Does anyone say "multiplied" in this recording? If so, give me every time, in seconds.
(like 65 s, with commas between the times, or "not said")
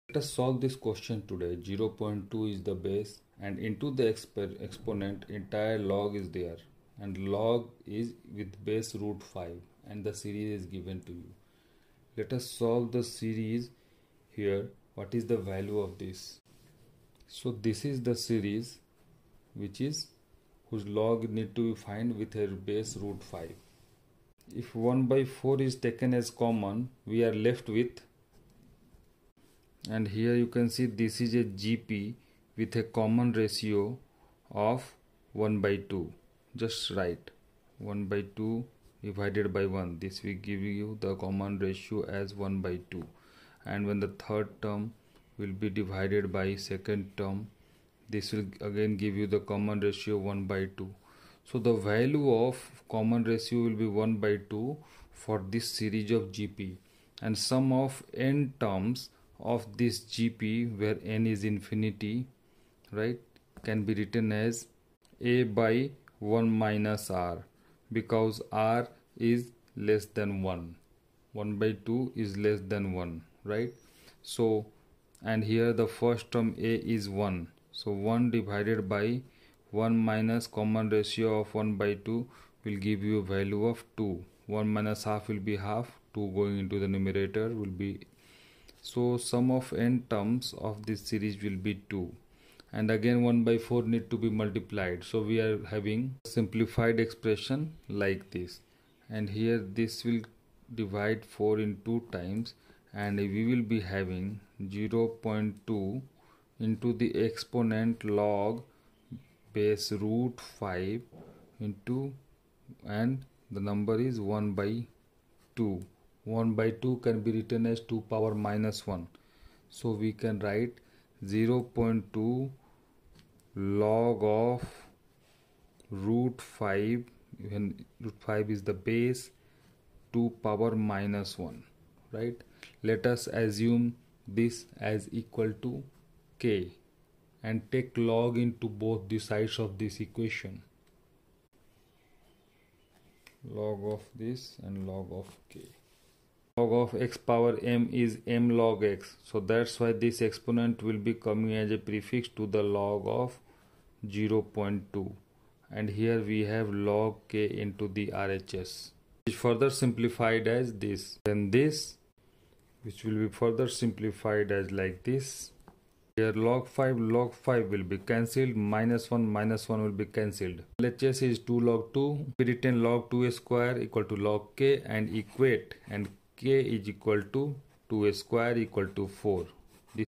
94 s.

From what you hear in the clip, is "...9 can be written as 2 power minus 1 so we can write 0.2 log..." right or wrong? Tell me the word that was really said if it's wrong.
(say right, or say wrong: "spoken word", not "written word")
wrong: "2", not "9".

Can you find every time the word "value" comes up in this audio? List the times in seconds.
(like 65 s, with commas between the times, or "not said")
15 s, 51 s, 83 s.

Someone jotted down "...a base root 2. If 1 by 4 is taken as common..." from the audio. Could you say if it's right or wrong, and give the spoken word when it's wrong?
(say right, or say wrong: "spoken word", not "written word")
wrong: "5", not "2".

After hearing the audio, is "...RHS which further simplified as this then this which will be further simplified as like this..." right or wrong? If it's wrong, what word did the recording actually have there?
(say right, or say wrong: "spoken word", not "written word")
right.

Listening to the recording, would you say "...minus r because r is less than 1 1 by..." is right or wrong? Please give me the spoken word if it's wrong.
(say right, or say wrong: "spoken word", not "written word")
right.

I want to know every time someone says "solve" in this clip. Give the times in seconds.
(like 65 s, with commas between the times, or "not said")
0 s, 12 s.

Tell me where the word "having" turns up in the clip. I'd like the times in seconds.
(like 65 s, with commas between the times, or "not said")
95 s, 103 s.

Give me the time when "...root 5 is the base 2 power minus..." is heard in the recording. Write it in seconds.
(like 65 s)
128 s.